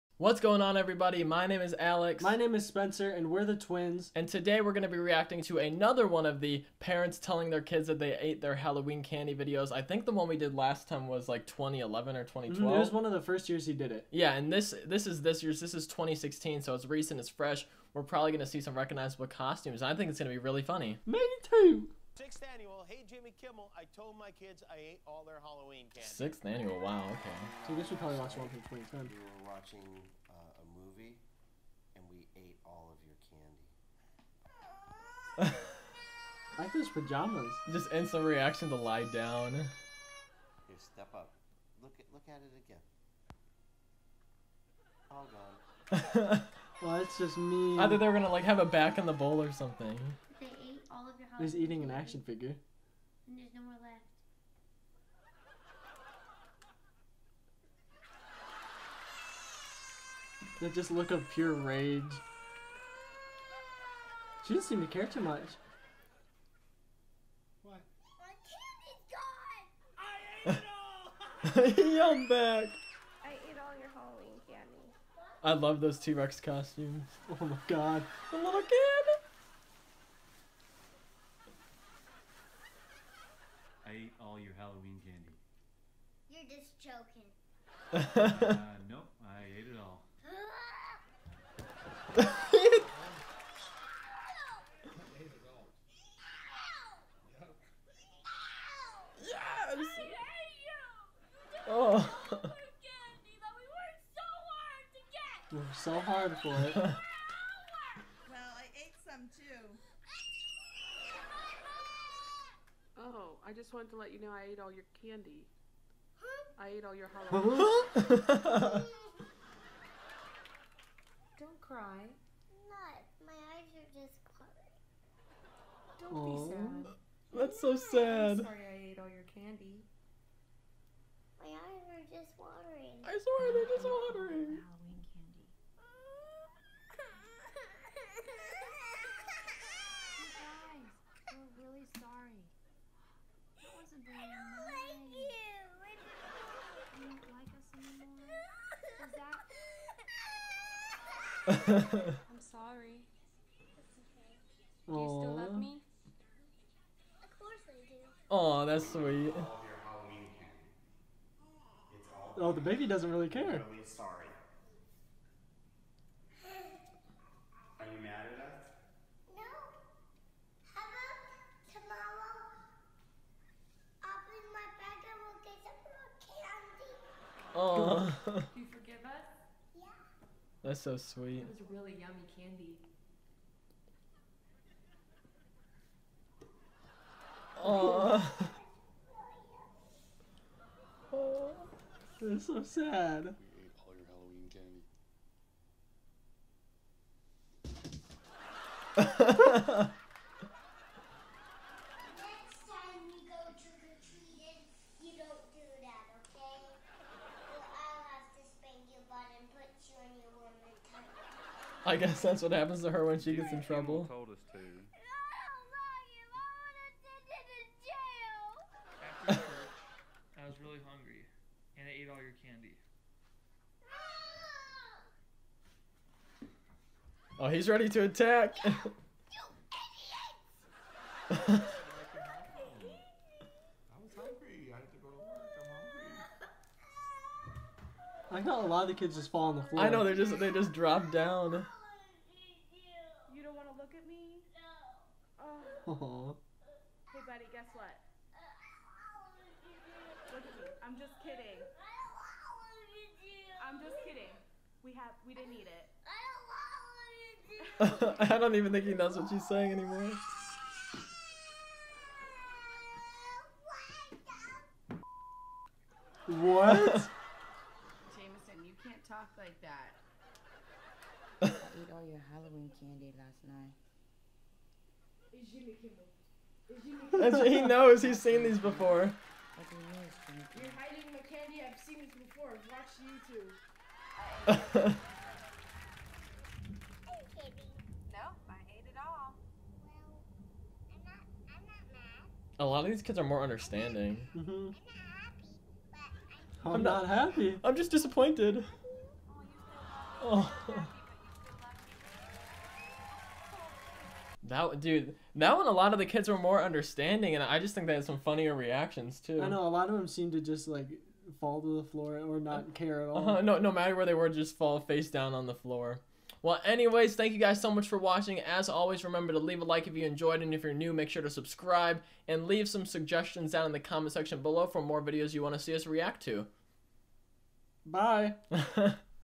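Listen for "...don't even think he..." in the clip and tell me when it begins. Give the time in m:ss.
4:18.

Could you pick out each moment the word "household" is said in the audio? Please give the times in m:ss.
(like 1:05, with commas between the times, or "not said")
not said.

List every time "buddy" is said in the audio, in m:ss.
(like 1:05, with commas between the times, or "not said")
4:07.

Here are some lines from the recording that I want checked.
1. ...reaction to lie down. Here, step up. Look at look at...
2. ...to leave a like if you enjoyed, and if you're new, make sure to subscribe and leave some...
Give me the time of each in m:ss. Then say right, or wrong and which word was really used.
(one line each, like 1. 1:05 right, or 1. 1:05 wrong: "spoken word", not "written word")
1. 0:38 right
2. 5:19 right.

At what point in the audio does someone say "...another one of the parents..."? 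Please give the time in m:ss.
0:05.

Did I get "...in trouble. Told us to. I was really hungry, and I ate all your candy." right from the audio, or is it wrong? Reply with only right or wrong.
right.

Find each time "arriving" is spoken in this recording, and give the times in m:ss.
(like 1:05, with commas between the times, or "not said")
not said.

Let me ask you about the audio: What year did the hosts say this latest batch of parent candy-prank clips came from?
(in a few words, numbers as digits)
2016.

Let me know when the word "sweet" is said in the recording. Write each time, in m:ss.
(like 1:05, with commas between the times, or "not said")
2:38, 3:00.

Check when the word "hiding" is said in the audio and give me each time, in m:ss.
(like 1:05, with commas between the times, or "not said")
4:40.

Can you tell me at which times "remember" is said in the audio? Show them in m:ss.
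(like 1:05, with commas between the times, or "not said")
5:19.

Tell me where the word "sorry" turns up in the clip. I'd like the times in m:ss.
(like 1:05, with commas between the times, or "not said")
2:08, 2:32, 2:43.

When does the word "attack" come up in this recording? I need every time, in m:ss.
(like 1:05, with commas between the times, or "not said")
3:48.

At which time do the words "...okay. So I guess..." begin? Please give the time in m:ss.
0:27.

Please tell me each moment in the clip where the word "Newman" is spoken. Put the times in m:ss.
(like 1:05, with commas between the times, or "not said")
not said.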